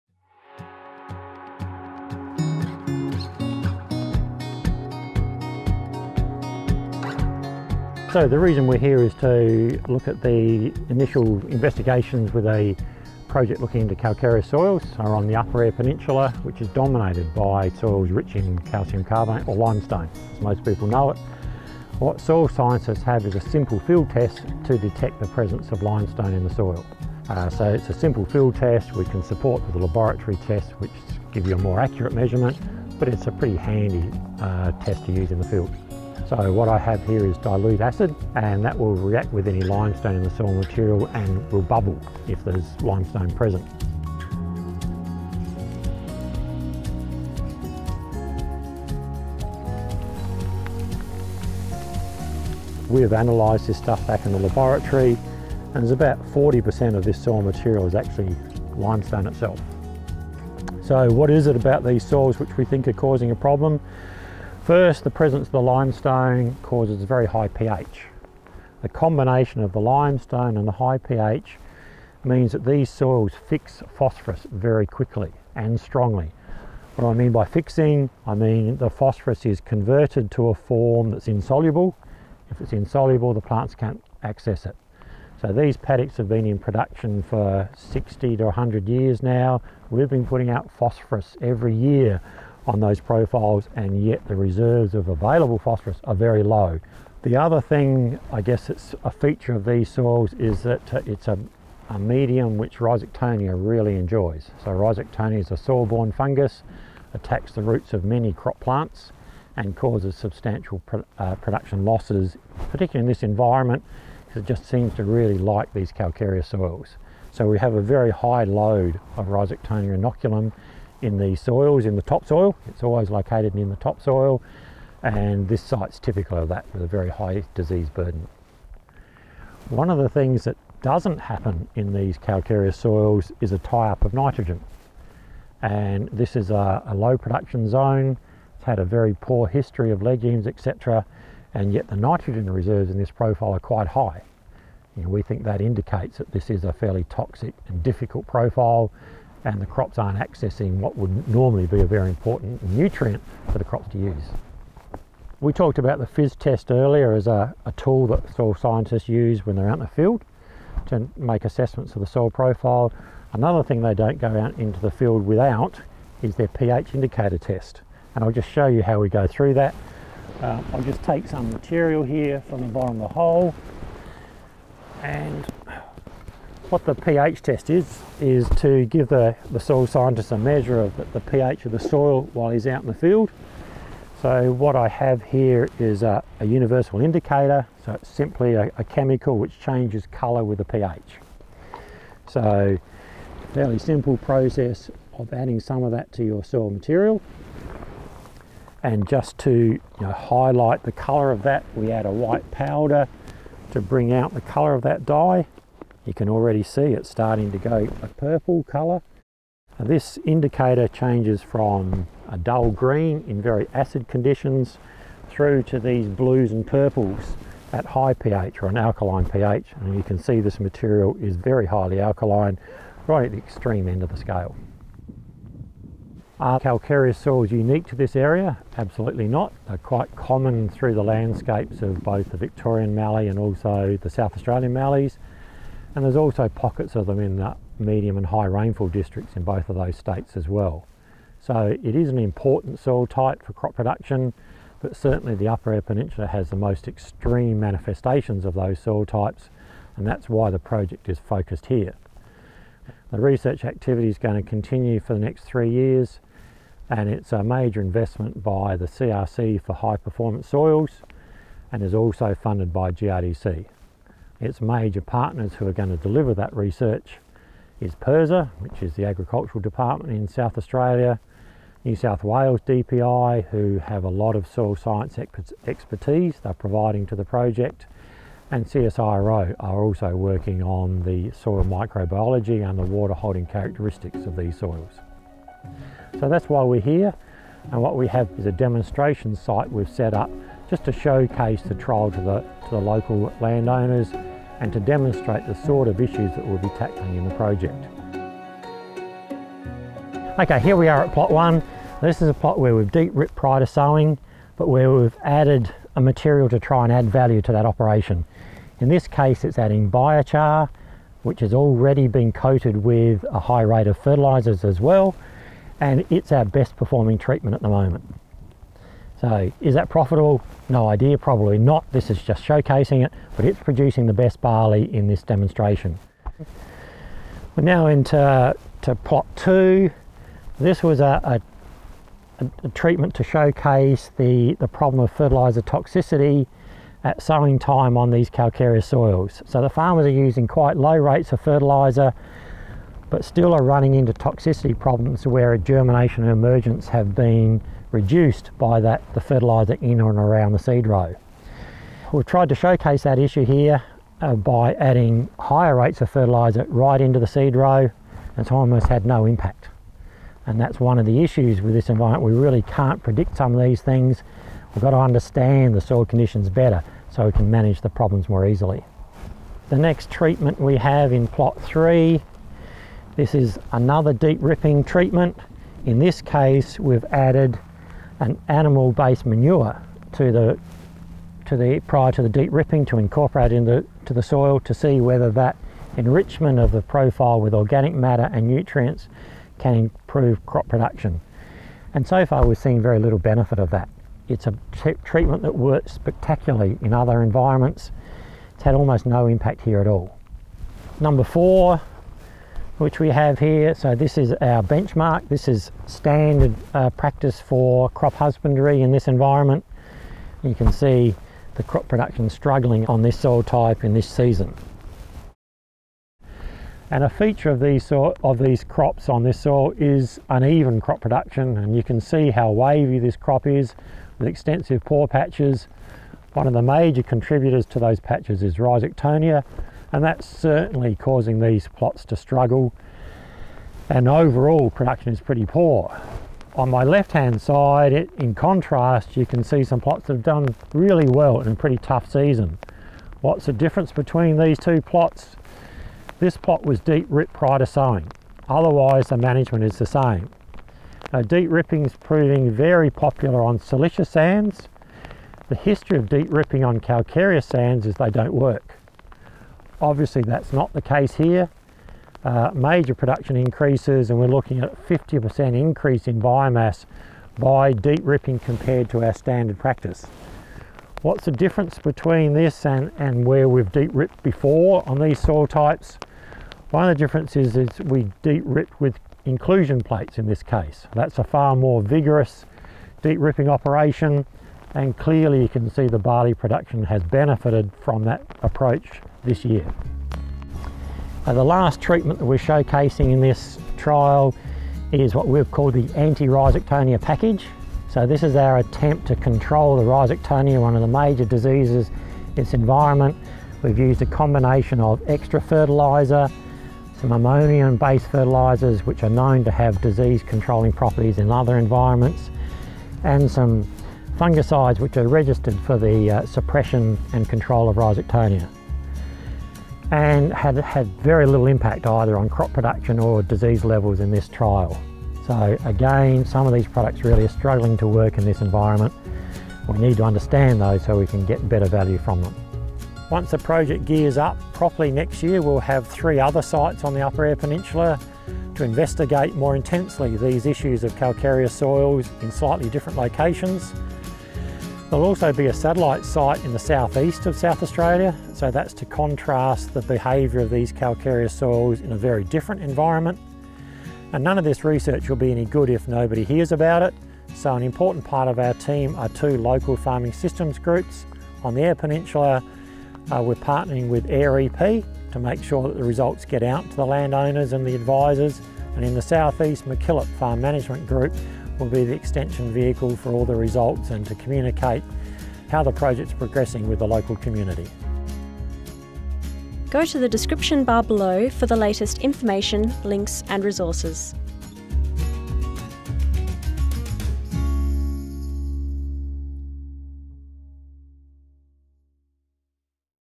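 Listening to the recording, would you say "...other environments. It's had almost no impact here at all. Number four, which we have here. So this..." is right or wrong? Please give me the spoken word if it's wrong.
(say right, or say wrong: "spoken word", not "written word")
right.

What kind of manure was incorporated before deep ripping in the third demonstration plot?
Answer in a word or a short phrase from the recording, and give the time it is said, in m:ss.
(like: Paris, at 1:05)
Animal-based manure, at 6:18.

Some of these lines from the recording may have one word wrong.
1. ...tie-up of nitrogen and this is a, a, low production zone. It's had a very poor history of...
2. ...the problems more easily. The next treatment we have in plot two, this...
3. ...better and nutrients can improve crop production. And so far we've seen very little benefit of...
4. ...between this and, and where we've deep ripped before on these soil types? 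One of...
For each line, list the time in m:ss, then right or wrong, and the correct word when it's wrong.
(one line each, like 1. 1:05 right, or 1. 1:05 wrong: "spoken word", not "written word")
1. 2:13 right
2. 6:07 wrong: "three", not "two"
3. 6:27 wrong: "matter", not "better"
4. 7:51 right.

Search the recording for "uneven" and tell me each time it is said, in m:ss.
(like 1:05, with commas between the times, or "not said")
7:00.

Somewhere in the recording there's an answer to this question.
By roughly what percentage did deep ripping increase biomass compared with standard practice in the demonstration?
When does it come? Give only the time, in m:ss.
7:44.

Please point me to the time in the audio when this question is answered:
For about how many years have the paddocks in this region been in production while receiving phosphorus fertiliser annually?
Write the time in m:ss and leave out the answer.
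1:27.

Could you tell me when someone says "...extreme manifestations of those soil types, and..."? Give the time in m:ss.
4:06.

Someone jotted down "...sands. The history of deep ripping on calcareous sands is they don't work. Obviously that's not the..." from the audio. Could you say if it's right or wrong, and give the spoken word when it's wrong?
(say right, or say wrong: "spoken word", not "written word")
right.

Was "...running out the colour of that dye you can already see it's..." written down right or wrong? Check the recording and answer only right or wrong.
wrong.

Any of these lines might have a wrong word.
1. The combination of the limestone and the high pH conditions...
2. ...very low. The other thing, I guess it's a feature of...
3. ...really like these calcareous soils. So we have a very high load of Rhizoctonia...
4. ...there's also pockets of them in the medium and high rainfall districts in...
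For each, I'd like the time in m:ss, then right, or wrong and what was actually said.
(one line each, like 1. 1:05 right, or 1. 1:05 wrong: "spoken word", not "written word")
1. 1:08 wrong: "means", not "conditions"
2. 1:36 right
3. 1:55 right
4. 3:56 right.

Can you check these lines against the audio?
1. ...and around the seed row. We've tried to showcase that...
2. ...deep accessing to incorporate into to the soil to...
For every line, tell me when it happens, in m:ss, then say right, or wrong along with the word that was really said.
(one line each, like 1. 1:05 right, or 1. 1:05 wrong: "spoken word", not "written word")
1. 5:50 right
2. 6:22 wrong: "ripping", not "accessing".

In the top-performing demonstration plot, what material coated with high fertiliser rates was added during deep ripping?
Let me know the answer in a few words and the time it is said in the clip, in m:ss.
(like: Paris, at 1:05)
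Biochar, at 5:09.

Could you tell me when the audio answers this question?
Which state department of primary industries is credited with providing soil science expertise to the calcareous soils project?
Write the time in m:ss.
4:31.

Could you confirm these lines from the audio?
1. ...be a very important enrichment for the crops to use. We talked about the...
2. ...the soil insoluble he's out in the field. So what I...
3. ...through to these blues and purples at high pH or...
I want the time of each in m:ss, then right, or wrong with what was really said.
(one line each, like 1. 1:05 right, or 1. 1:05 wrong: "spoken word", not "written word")
1. 2:31 wrong: "nutrient", not "enrichment"
2. 3:01 wrong: "while", not "insoluble"
3. 3:35 right.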